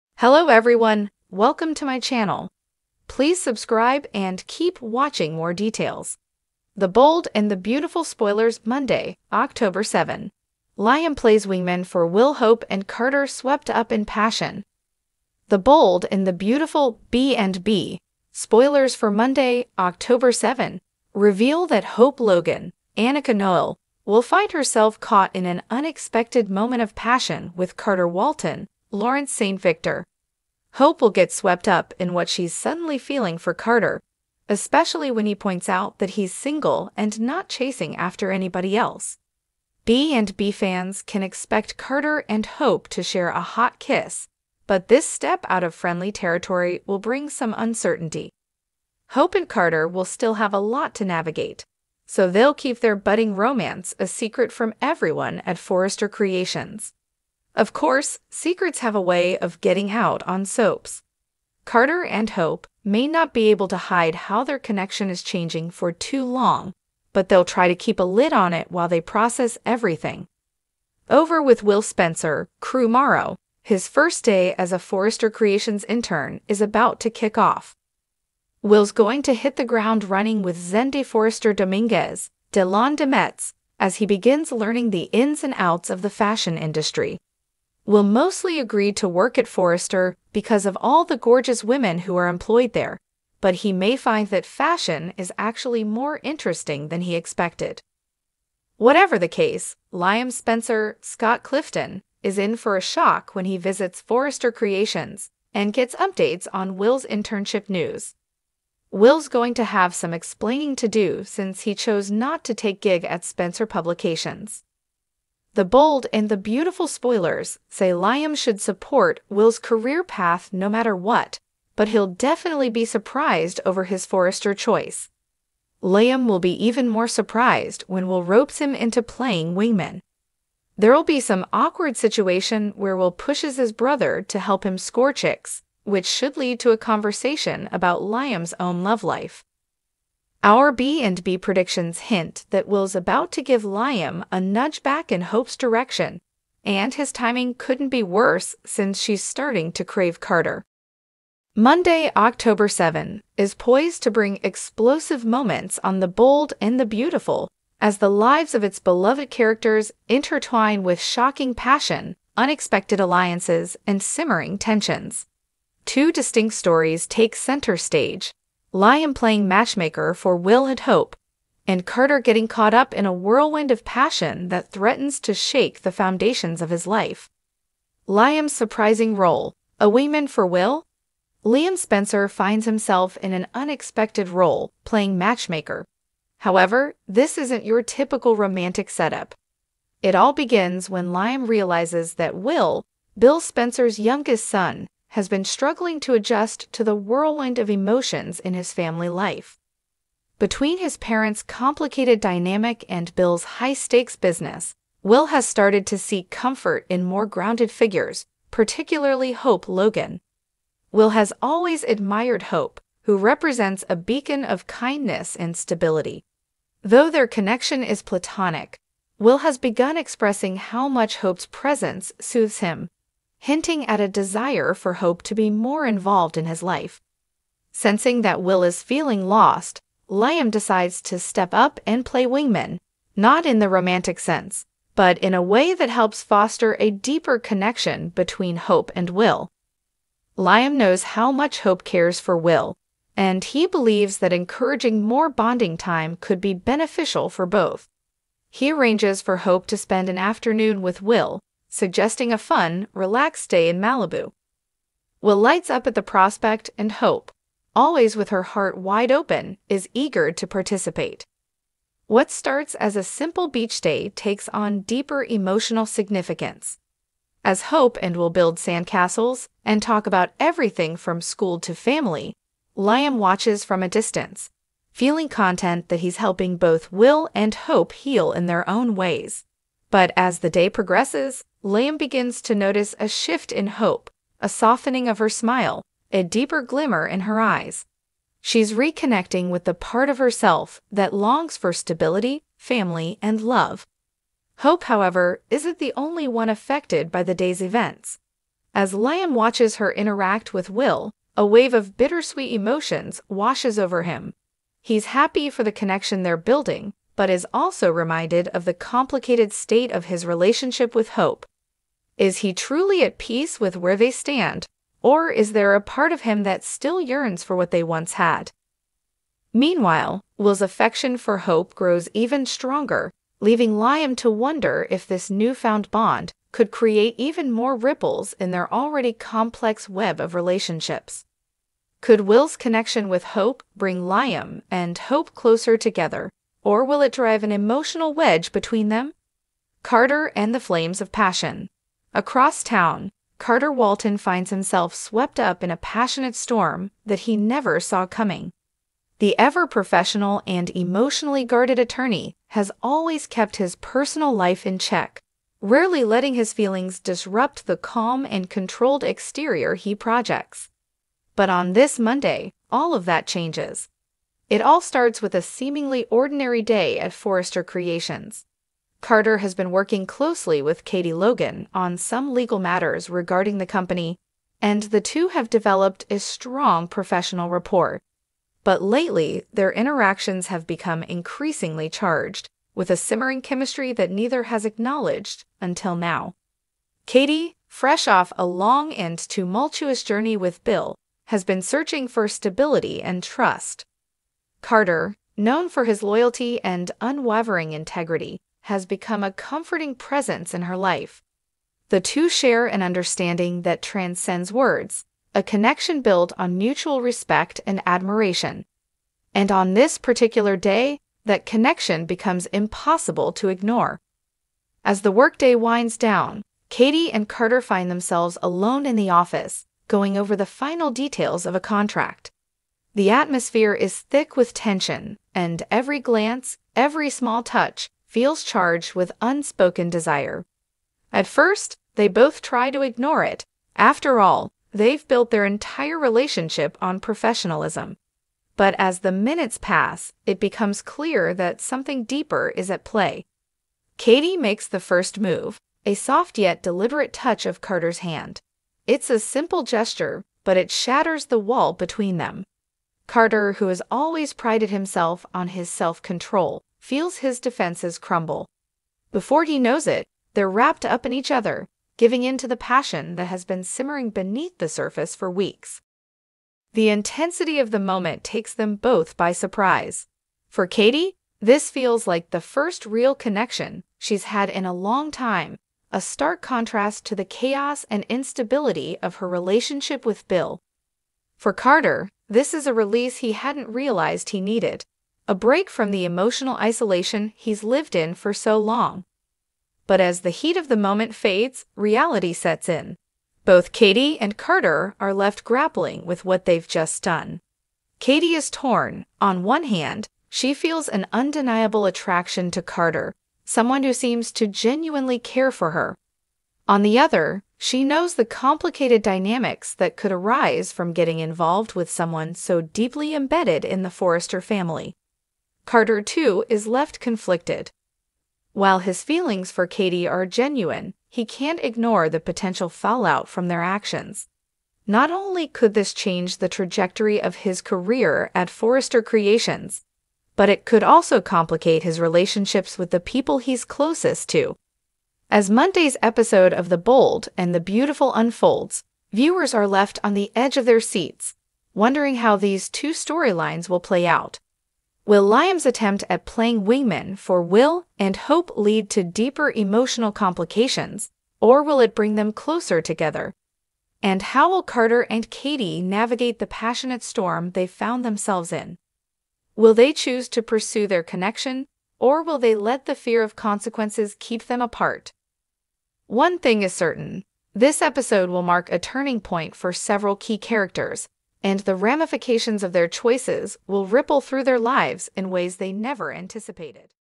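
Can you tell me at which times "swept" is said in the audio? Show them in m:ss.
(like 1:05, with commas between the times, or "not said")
0:13, 0:31, 5:44.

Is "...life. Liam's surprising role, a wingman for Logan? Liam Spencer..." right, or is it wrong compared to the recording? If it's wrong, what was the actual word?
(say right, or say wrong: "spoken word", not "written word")
wrong: "Will", not "Logan".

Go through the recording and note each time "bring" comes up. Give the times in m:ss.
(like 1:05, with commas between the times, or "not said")
0:46, 2:34, 5:33, 9:11.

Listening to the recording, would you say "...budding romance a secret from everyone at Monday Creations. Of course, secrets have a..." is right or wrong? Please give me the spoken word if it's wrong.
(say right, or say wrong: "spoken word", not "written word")
wrong: "Forrester", not "Monday".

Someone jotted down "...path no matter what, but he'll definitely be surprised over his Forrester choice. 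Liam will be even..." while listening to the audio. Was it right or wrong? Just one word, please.
right.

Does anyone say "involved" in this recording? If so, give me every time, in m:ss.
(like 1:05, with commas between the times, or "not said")
3:45, 8:31.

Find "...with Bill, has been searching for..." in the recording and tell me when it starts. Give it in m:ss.
6:30.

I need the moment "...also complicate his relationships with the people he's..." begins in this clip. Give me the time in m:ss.
8:50.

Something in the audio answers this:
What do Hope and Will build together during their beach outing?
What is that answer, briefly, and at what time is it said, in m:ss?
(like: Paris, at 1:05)
Sandcastles, at 4:28.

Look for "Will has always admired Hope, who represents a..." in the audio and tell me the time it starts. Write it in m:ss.
3:30.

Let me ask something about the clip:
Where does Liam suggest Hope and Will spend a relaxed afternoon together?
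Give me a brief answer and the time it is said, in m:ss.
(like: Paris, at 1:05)
Malibu, at 4:13.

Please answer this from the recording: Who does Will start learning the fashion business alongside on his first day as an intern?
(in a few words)
Zende Forrester Dominguez.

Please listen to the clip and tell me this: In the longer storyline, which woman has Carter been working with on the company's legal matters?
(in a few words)
Katie Logan.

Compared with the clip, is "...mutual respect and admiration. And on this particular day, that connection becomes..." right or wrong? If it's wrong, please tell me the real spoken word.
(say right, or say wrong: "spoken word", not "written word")
right.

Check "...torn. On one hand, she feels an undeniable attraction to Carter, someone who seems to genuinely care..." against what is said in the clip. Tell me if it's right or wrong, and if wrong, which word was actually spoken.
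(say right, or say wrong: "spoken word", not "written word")
right.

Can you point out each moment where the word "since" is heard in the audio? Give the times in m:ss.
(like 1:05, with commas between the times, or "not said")
1:51, 2:28.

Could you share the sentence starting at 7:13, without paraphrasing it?
After all, they've built their entire relationship on professionalism.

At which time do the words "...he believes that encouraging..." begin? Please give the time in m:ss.
4:03.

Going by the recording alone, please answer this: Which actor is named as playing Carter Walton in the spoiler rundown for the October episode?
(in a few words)
Lawrence St. Victor.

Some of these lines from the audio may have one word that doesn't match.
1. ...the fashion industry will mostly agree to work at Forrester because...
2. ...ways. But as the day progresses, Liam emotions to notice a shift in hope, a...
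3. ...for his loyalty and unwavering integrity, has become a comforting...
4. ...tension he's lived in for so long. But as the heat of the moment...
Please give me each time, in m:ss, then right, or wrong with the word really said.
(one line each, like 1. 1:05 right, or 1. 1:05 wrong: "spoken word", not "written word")
1. 1:26 right
2. 4:38 wrong: "begins", not "emotions"
3. 6:35 right
4. 8:06 wrong: "isolation", not "tension".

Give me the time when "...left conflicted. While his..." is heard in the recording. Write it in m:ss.
8:36.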